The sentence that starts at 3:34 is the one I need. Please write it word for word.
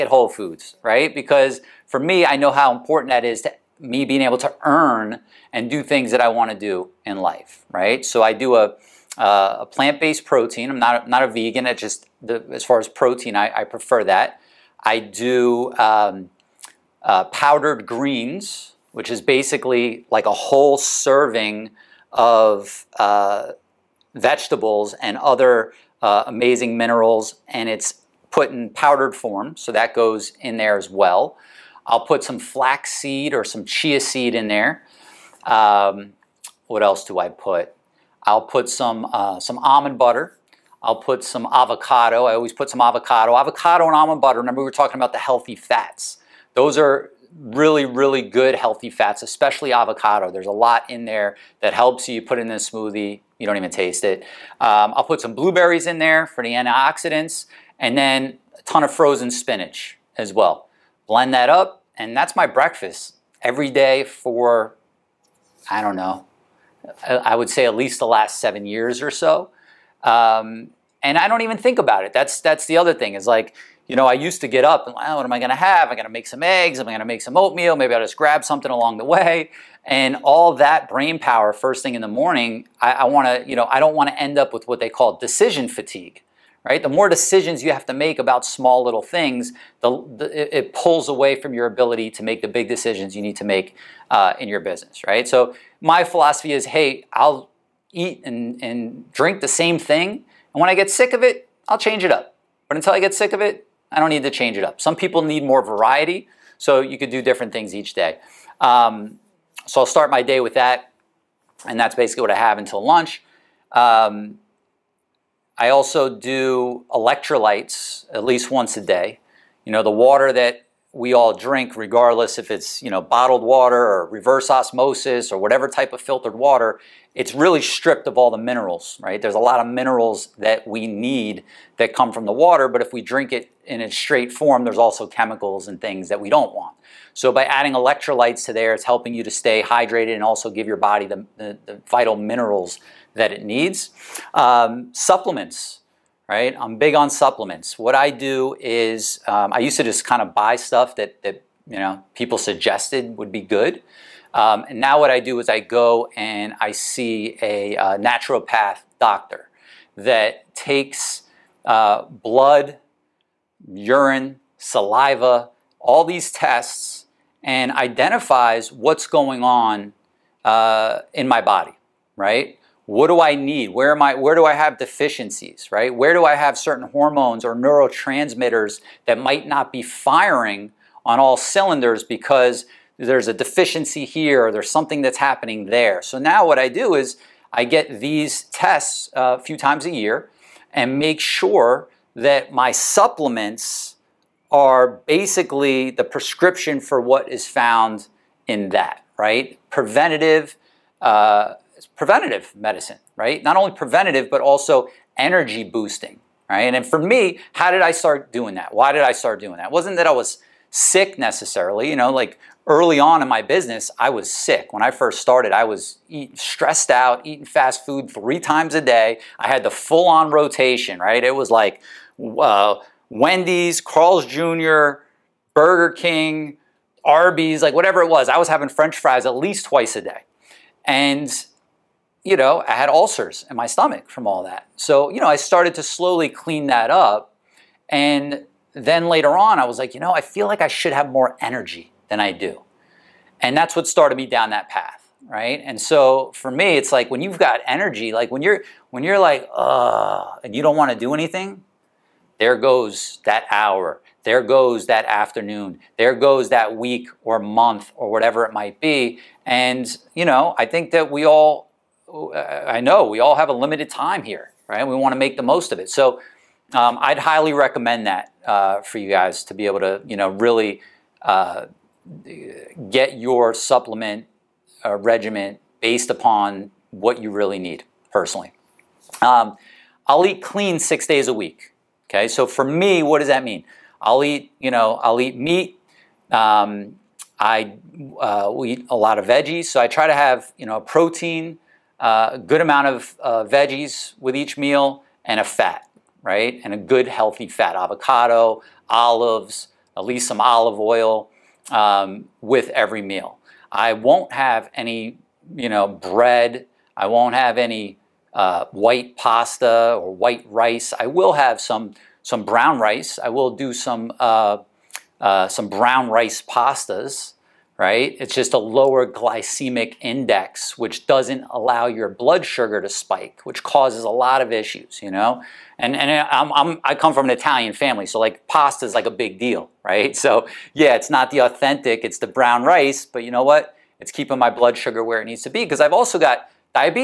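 When I first started, I was eat, stressed out, eating fast food three times a day.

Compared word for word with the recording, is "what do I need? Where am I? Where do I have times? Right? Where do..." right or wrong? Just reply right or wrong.
wrong.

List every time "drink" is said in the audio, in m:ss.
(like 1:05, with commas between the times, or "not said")
1:39, 2:01, 2:13.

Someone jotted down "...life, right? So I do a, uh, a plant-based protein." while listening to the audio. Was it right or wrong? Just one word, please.
right.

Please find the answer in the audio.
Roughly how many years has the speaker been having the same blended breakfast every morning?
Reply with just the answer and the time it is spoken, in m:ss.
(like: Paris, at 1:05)
7 years, at 1:08.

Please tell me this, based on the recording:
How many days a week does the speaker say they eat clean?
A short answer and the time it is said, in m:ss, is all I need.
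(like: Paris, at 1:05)
6, at 4:40.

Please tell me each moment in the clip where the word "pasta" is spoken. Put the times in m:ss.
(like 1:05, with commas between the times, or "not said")
5:09, 5:16, 5:28.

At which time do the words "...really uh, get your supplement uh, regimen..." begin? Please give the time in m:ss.
4:30.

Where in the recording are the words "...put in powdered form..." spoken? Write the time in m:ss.
0:28.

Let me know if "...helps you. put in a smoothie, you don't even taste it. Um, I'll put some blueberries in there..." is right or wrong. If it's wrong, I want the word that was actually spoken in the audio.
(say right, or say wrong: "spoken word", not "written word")
right.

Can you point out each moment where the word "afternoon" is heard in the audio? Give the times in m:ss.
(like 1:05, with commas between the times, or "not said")
4:15.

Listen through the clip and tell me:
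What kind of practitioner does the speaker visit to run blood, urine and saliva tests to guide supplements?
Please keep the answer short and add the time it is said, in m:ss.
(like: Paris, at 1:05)
naturopath doctor, at 2:37.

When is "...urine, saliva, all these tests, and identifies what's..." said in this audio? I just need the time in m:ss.
2:43.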